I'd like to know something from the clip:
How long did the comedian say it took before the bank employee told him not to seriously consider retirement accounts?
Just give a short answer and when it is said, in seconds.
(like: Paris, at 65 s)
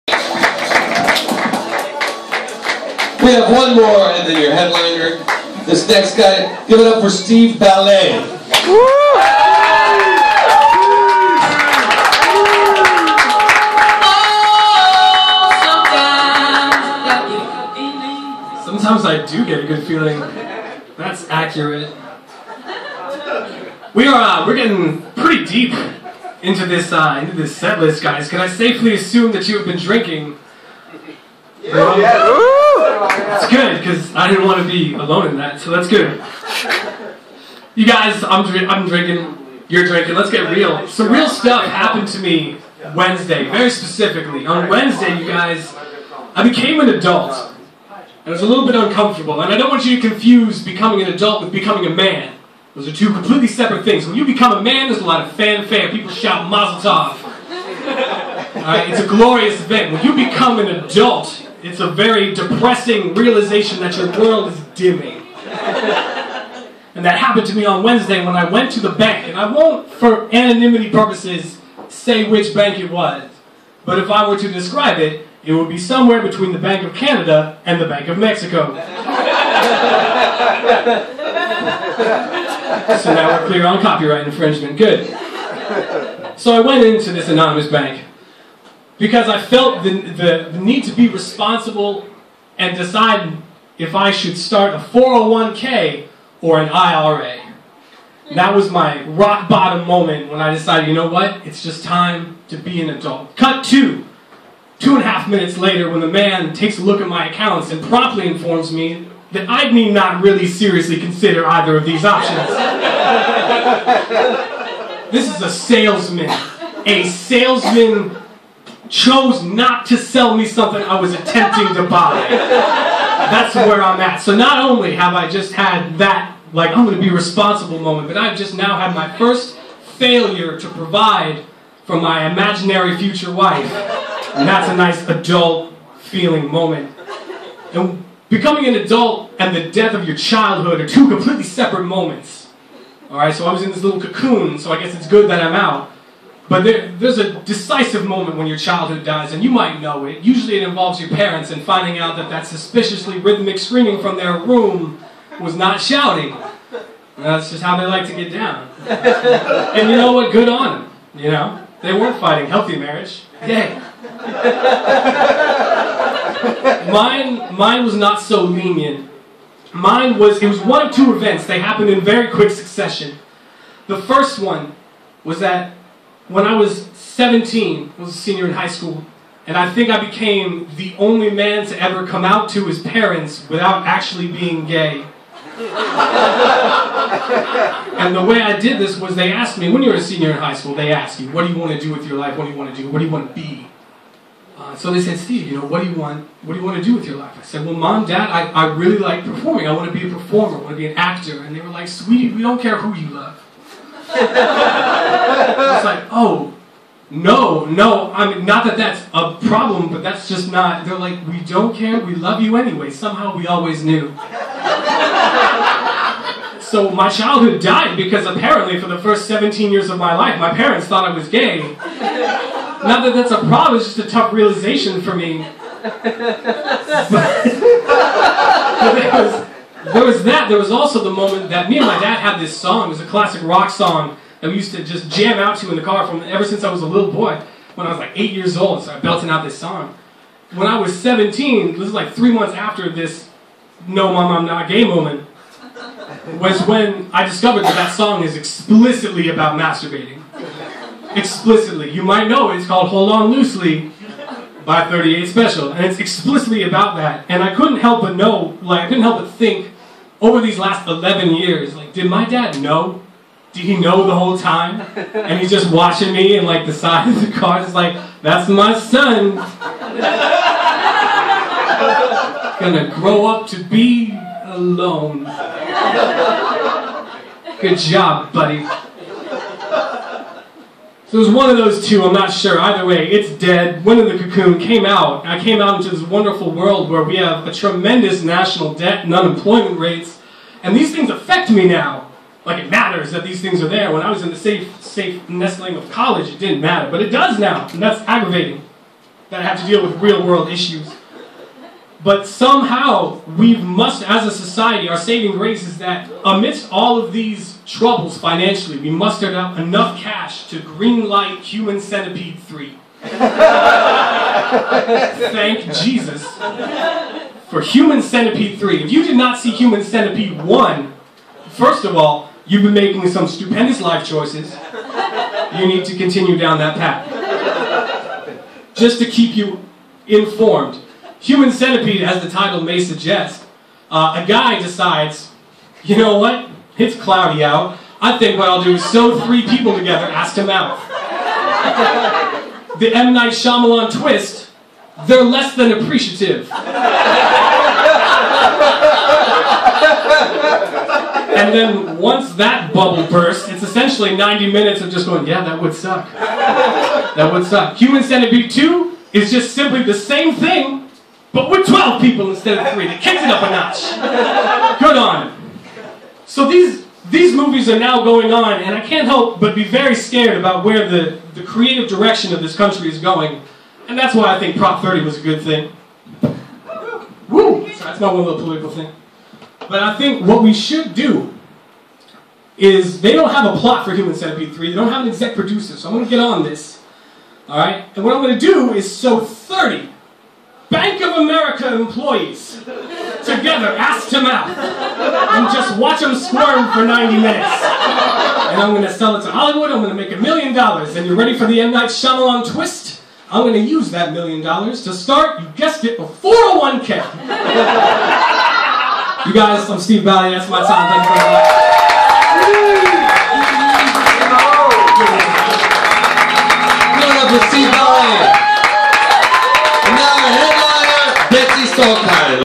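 Two and a half minutes, at 104 s.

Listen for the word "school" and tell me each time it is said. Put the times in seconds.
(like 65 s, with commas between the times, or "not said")
178 s, 190 s.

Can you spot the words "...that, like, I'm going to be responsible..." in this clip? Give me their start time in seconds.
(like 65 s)
125 s.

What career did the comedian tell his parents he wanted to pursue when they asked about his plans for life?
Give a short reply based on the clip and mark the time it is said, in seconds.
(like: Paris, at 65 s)
Actor, at 200 s.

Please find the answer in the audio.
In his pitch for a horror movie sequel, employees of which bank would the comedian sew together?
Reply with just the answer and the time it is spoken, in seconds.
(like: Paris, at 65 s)
Bank of America, at 390 s.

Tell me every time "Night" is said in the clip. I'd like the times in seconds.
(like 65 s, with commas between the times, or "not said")
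343 s, 401 s.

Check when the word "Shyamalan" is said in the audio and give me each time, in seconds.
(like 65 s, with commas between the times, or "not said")
343 s, 401 s.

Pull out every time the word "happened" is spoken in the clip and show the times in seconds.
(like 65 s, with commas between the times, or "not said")
41 s, 67 s, 171 s.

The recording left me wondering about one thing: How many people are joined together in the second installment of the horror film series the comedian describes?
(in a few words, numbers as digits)
12.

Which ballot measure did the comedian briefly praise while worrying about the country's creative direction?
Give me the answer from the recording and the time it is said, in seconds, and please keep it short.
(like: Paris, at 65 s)
Prop 30, at 374 s.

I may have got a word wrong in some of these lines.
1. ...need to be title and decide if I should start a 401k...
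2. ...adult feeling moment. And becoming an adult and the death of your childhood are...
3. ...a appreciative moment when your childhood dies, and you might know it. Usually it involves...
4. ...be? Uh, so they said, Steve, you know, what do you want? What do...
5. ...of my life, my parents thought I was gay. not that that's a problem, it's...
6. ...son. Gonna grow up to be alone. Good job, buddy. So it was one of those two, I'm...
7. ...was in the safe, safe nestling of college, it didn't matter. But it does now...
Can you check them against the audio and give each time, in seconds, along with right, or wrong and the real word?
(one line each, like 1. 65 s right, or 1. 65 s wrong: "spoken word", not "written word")
1. 90 s wrong: "responsible", not "title"
2. 135 s right
3. 147 s wrong: "decisive", not "appreciative"
4. 193 s right
5. 219 s right
6. 268 s right
7. 294 s right.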